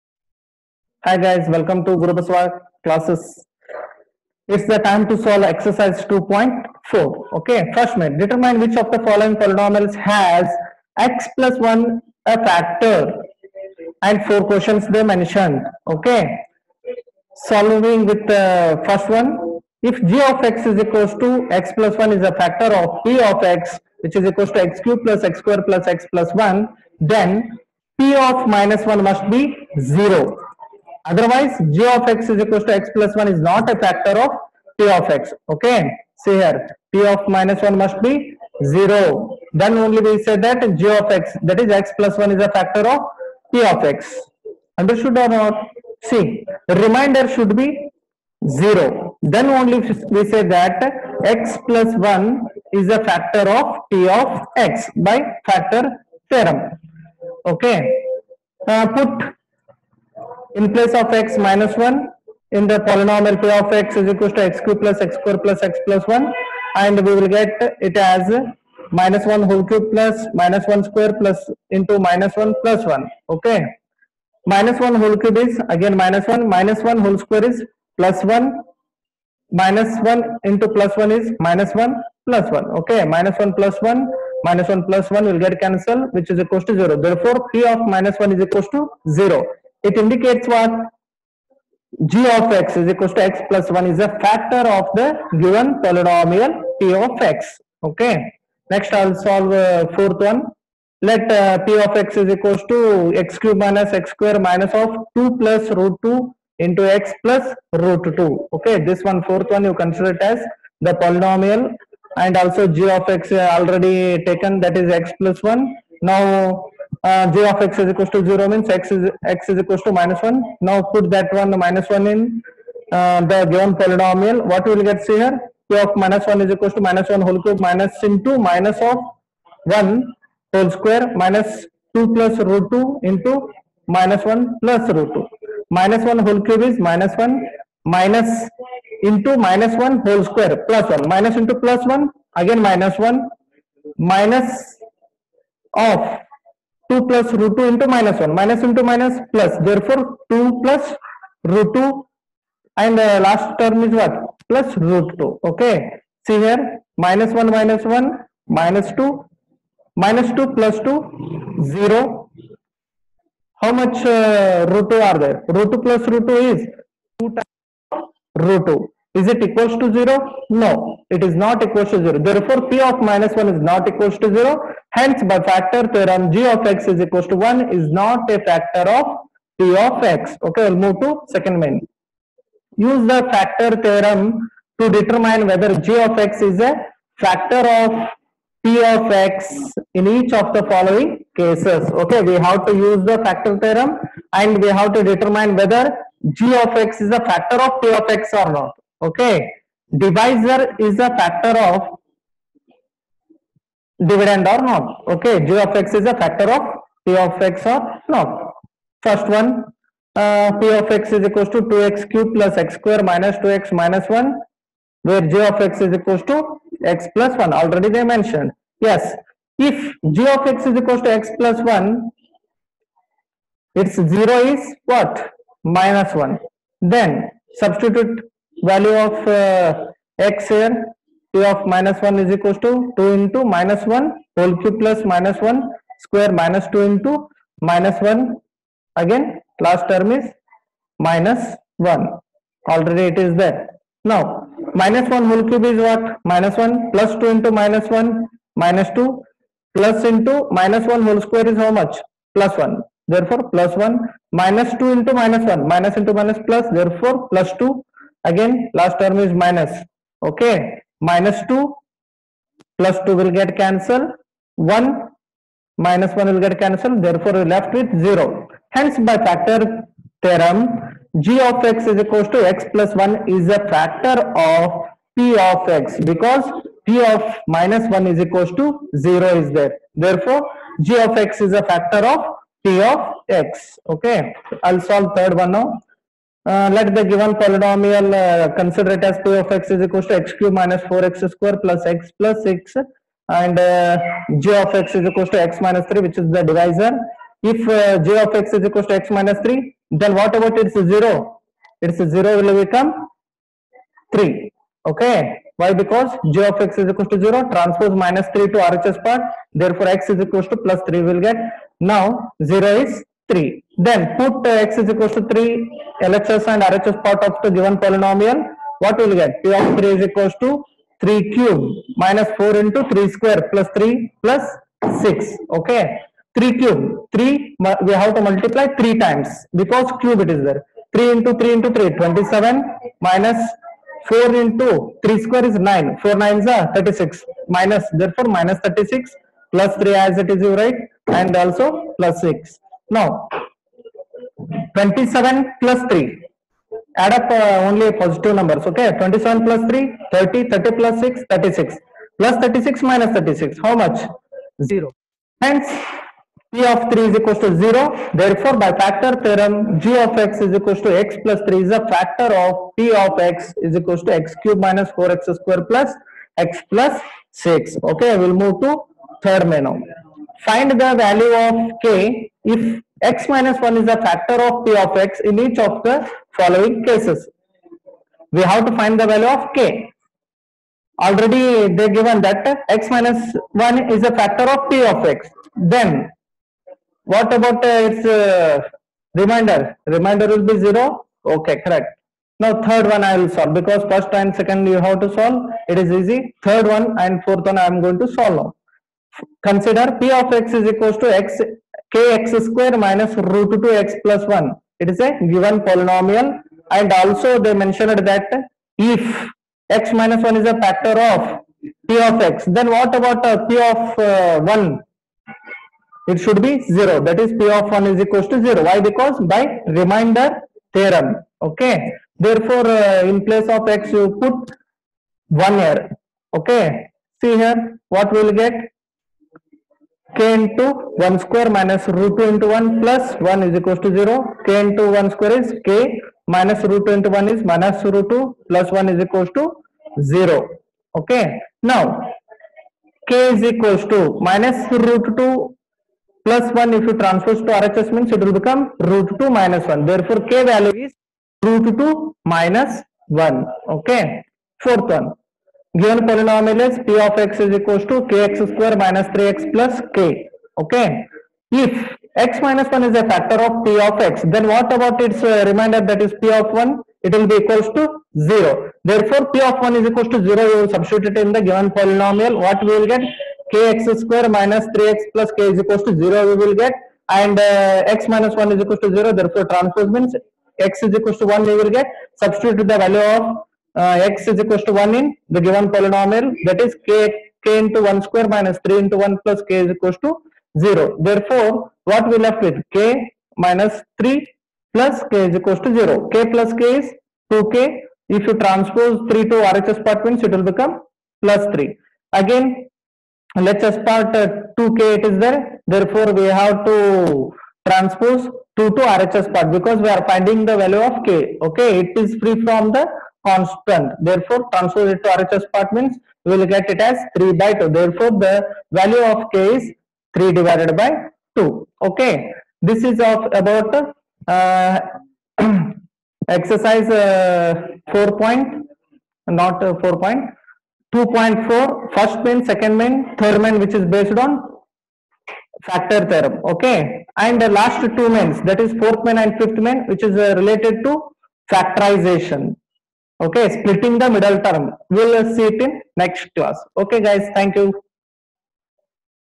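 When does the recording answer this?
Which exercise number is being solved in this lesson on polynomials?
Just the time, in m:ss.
0:05.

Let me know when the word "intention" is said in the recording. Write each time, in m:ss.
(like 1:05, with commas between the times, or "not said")
not said.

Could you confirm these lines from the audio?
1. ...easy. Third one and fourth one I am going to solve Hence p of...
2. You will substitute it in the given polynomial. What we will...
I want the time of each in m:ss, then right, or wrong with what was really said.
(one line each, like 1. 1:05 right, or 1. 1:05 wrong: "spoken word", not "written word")
1. 6:35 wrong: "Consider", not "Hence"
2. 7:50 right.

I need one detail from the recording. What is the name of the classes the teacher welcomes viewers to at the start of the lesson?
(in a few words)
Guru Basava classes.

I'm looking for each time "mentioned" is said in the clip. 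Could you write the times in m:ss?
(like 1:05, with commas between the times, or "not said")
0:15, 3:38, 6:47.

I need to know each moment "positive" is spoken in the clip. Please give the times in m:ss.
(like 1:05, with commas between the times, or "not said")
5:47.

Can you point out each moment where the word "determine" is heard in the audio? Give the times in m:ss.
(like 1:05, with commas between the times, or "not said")
0:08, 3:04, 3:15.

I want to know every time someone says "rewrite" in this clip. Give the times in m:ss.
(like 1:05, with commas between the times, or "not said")
not said.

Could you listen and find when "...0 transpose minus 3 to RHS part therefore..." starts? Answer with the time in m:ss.
5:07.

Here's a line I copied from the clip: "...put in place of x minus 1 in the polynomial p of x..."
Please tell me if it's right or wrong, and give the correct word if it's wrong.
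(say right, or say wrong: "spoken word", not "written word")
right.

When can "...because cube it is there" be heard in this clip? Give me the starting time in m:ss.
5:29.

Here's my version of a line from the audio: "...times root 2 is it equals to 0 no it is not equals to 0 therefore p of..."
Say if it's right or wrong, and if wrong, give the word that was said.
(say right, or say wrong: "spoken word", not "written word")
right.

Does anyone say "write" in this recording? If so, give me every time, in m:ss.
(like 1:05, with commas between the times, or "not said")
5:40.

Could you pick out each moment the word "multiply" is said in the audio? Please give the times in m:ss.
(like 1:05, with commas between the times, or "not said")
5:28.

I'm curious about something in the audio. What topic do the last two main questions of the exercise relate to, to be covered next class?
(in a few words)
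factorization.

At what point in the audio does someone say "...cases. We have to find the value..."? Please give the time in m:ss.
6:16.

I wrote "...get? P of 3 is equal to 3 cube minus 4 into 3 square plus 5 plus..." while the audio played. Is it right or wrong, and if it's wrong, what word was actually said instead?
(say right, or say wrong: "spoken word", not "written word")
wrong: "3", not "5".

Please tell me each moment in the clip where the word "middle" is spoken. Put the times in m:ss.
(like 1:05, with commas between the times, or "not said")
9:04.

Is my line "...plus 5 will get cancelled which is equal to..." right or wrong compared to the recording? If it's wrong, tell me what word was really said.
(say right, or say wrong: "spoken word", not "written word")
wrong: "1", not "5".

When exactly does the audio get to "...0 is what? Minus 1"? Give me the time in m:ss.
3:43.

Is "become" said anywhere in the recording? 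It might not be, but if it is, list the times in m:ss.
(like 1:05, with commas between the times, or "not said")
5:02, 7:28, 8:20.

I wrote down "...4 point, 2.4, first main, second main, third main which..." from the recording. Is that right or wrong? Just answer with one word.
right.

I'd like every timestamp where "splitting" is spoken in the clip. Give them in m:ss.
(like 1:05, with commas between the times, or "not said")
9:03.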